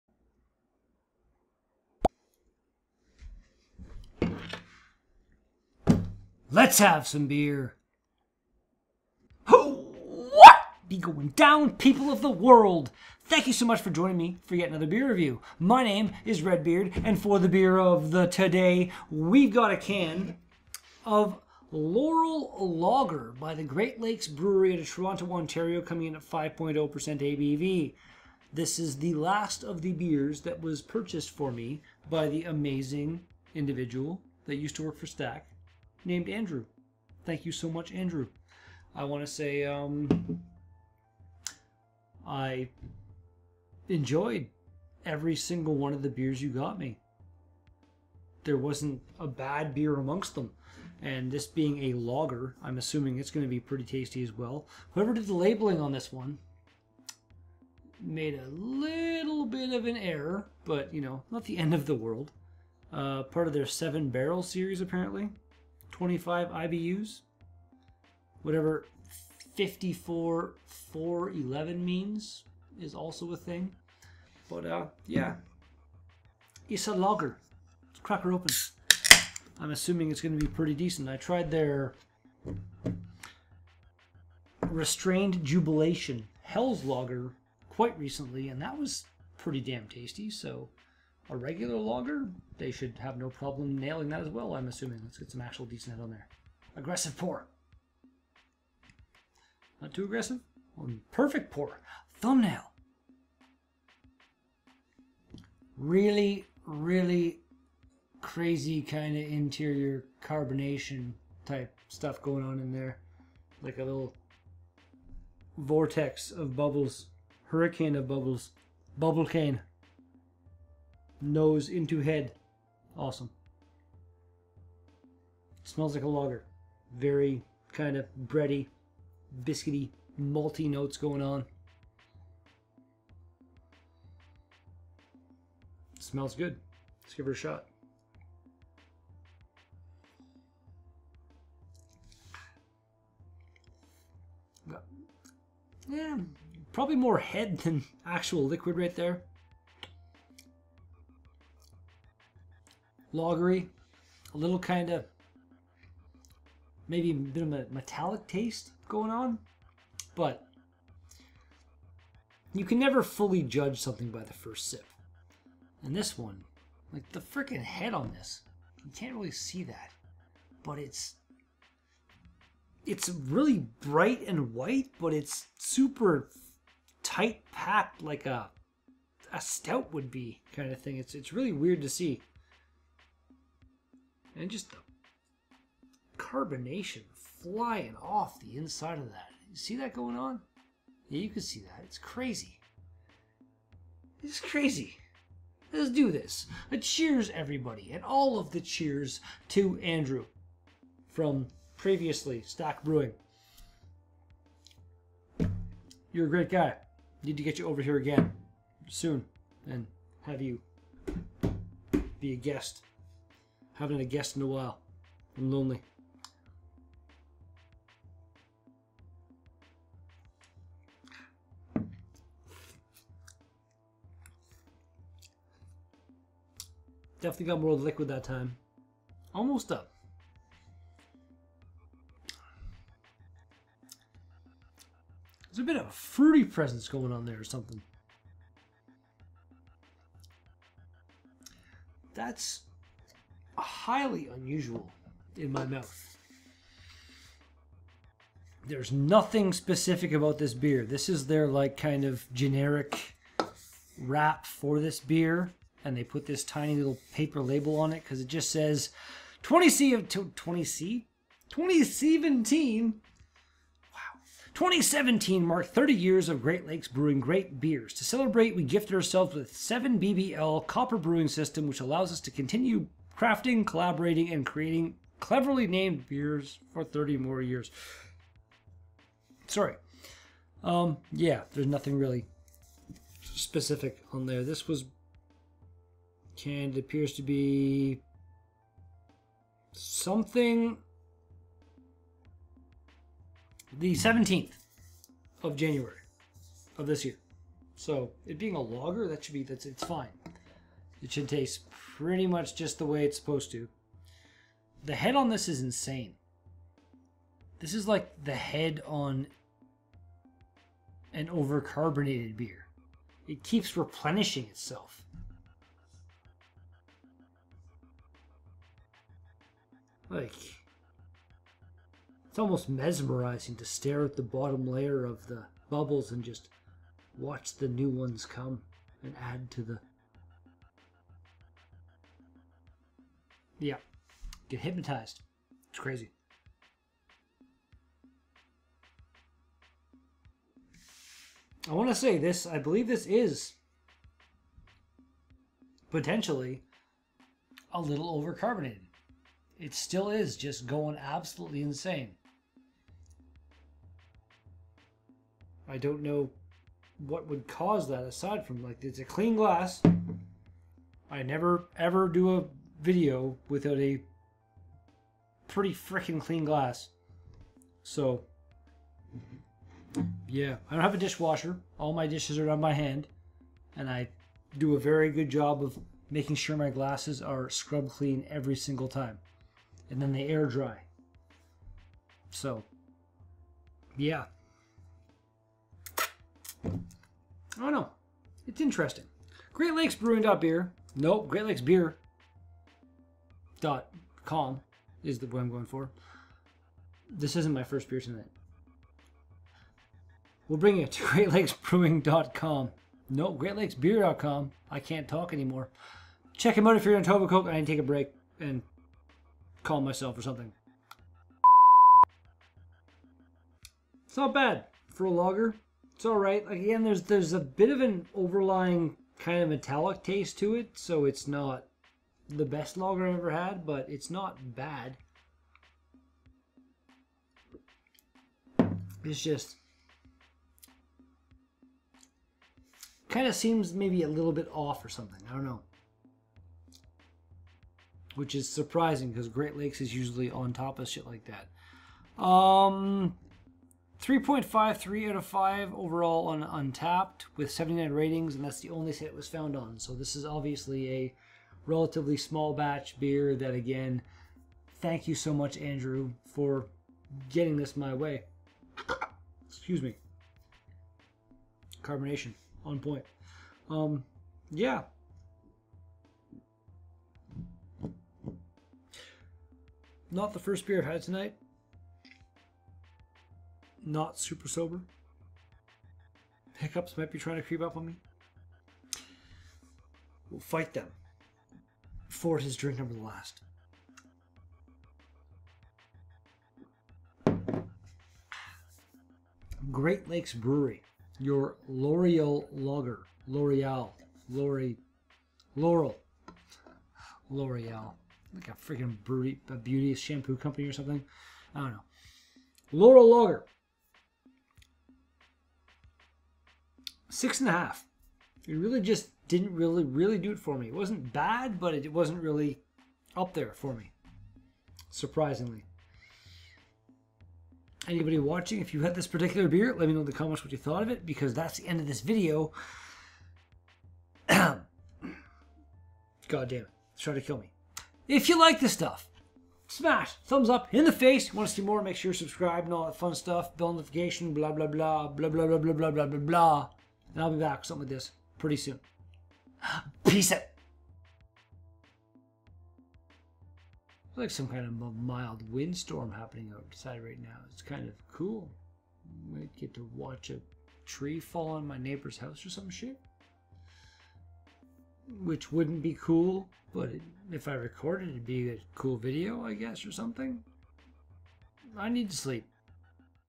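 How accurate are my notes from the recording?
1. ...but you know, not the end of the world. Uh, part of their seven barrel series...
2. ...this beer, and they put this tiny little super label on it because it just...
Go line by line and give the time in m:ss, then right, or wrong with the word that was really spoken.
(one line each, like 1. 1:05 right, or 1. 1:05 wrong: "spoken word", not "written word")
1. 1:00 right
2. 4:14 wrong: "paper", not "super".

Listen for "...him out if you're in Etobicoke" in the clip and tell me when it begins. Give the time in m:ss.
6:46.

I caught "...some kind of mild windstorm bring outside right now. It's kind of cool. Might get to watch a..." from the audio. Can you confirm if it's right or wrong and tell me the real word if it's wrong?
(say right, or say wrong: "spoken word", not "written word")
wrong: "happening", not "bring".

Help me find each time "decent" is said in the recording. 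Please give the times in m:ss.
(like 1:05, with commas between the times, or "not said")
1:20, 1:35.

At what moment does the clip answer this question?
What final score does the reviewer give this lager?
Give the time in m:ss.
8:27.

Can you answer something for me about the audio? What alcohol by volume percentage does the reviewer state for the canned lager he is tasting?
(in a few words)
5.0%.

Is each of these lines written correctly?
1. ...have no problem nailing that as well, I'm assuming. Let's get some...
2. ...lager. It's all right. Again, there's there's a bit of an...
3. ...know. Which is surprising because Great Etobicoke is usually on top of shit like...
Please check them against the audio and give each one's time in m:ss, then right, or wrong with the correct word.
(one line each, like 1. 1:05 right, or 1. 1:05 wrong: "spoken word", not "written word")
1. 1:32 right
2. 6:55 right
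3. 7:15 wrong: "Lakes", not "Etobicoke".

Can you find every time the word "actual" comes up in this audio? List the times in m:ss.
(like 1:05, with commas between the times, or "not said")
1:35, 2:28.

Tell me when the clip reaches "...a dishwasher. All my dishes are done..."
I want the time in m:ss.
6:10.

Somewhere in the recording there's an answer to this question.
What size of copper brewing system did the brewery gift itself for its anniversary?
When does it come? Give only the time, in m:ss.
4:29.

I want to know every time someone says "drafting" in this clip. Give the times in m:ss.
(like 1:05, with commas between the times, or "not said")
not said.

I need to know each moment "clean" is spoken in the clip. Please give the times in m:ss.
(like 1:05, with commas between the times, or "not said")
5:59, 6:06, 6:17.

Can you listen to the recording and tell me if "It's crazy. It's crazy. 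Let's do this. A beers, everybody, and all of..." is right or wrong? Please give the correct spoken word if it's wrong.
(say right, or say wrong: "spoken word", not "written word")
wrong: "cheers", not "beers".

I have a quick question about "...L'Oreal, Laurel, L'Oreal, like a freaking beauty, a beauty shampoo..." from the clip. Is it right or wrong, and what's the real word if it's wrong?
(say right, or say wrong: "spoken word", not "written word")
right.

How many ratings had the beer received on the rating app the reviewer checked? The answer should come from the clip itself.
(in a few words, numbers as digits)
79.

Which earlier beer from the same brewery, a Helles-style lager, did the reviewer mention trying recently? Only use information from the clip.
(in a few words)
Restrained Jubilation.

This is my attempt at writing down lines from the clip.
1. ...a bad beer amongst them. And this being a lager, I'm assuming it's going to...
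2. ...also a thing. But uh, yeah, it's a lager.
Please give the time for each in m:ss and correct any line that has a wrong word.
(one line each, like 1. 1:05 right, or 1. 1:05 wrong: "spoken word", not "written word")
1. 0:49 right
2. 1:12 right.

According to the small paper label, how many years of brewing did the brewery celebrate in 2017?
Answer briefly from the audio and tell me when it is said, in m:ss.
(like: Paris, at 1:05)
30, at 4:25.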